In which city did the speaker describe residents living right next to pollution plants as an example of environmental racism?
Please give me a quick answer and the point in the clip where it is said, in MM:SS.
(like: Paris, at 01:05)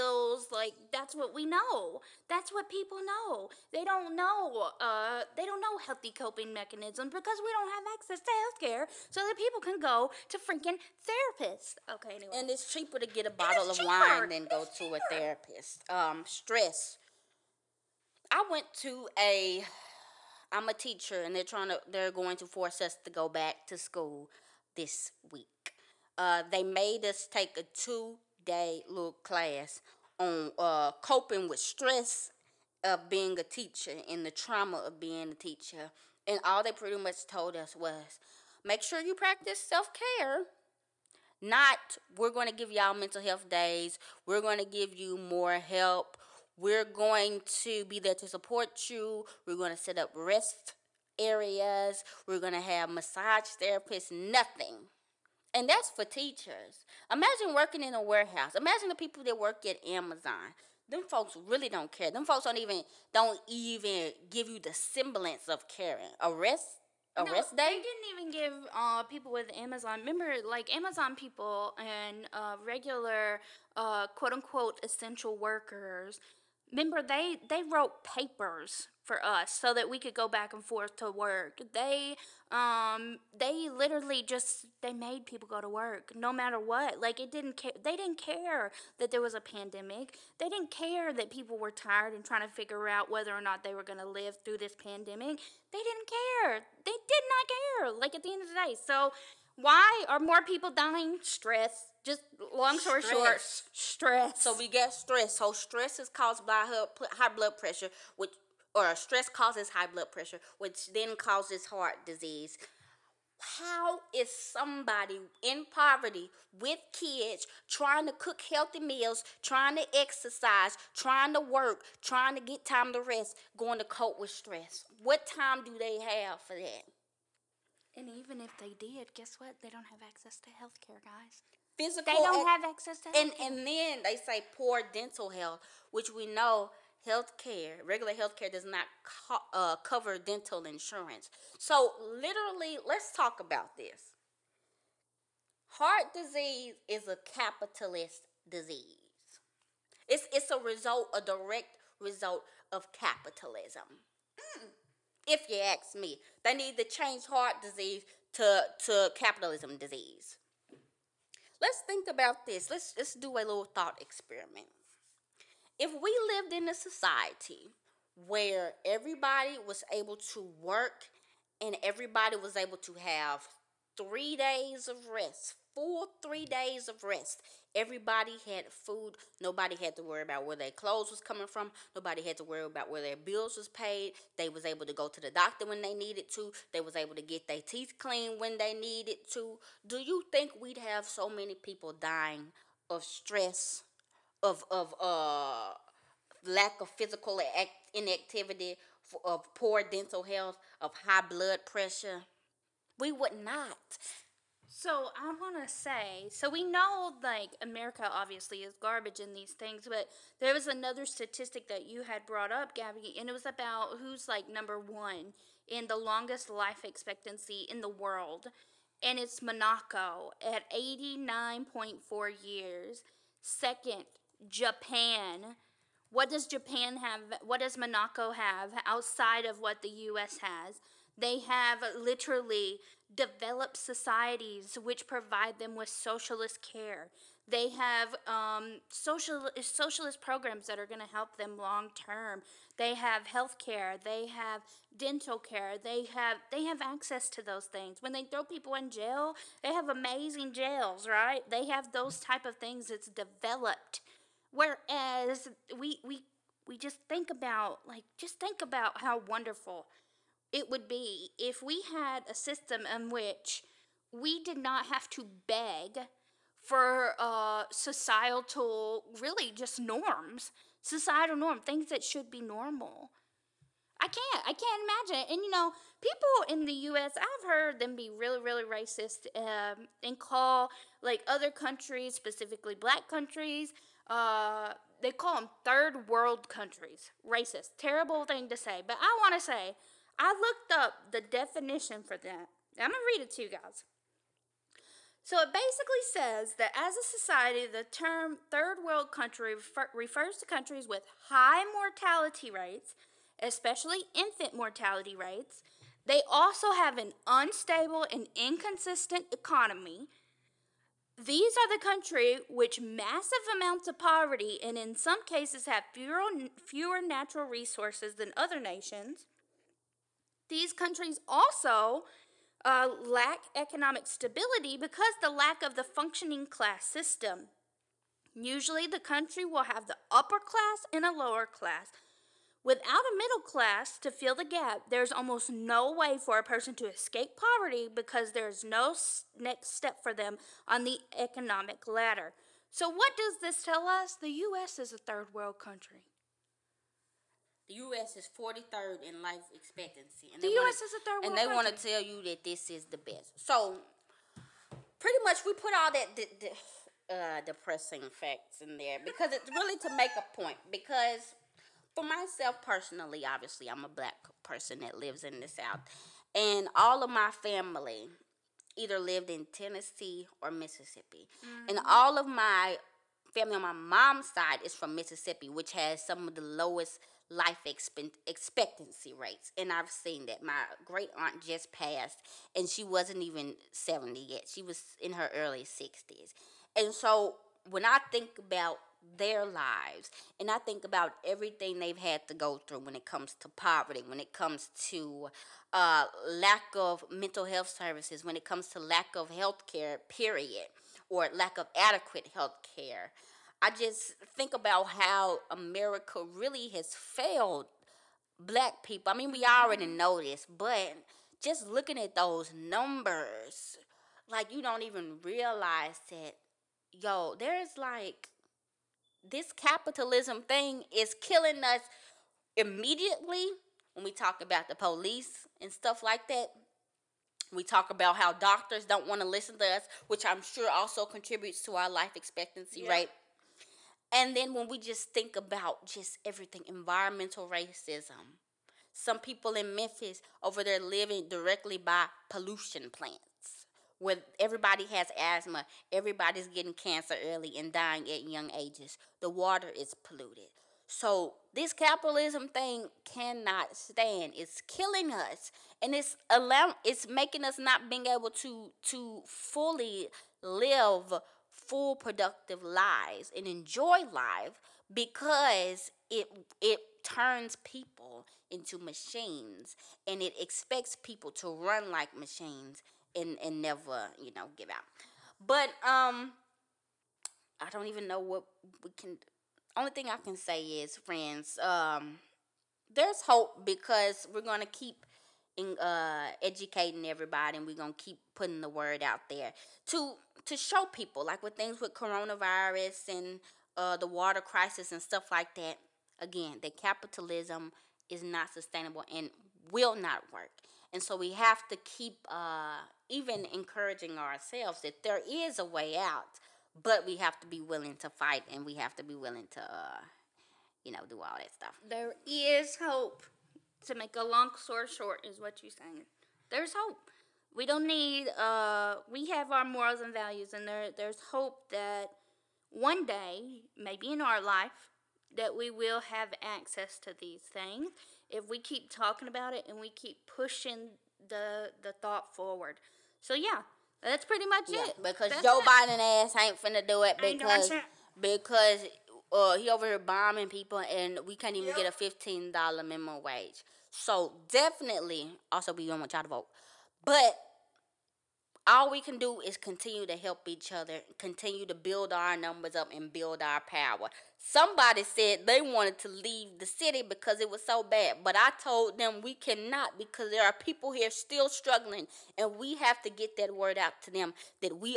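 Memphis, at 07:19.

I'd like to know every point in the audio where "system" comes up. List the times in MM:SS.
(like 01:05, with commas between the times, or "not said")
04:22, 05:26.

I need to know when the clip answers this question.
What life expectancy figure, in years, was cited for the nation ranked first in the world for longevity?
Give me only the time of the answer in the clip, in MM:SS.
03:40.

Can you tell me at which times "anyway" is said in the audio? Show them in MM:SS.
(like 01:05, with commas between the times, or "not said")
00:12.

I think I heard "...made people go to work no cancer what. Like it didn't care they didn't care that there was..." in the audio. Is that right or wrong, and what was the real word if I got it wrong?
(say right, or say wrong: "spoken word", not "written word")
wrong: "matter", not "cancer".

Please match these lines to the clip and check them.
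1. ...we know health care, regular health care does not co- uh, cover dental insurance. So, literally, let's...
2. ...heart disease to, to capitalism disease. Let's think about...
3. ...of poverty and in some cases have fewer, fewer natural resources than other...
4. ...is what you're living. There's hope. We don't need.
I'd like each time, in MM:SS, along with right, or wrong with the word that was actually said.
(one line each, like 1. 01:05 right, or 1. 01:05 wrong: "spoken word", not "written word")
1. 02:16 right
2. 02:37 right
3. 05:13 right
4. 08:35 wrong: "saying", not "living".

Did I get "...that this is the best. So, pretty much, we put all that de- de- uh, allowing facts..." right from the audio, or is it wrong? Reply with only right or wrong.
wrong.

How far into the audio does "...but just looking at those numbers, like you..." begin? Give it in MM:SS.
06:50.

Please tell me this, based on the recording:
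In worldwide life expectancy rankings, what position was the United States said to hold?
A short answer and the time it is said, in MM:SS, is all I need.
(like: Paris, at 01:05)
43rd, at 05:48.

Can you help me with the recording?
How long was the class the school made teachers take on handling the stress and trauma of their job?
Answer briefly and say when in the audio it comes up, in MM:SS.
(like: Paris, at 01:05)
2 day, at 00:27.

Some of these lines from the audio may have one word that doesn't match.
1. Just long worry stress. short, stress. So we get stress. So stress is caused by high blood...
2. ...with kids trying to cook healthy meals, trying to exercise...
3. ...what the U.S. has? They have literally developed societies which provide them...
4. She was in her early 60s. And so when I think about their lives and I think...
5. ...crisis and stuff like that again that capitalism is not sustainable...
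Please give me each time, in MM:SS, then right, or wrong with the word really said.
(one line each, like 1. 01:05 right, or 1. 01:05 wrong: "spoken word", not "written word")
1. 01:42 wrong: "story", not "worry"
2. 01:56 right
3. 03:49 right
4. 06:24 right
5. 08:14 right.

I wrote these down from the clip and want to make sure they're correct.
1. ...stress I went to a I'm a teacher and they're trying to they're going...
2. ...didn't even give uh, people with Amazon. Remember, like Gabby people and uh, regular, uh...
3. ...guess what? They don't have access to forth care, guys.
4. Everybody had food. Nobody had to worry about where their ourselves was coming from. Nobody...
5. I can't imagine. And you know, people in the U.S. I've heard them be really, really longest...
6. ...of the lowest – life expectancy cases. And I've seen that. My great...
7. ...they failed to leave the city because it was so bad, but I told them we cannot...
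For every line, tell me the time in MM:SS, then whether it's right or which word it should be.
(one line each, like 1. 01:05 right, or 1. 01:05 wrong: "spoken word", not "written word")
1. 00:16 right
2. 01:07 wrong: "Amazon", not "Gabby"
3. 02:09 wrong: "health", not "forth"
4. 02:57 wrong: "clothes", not "ourselves"
5. 04:34 wrong: "racist", not "longest"
6. 06:16 wrong: "rates", not "cases"
7. 09:15 wrong: "wanted", not "failed".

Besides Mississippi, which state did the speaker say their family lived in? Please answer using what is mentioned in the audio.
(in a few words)
Tennessee.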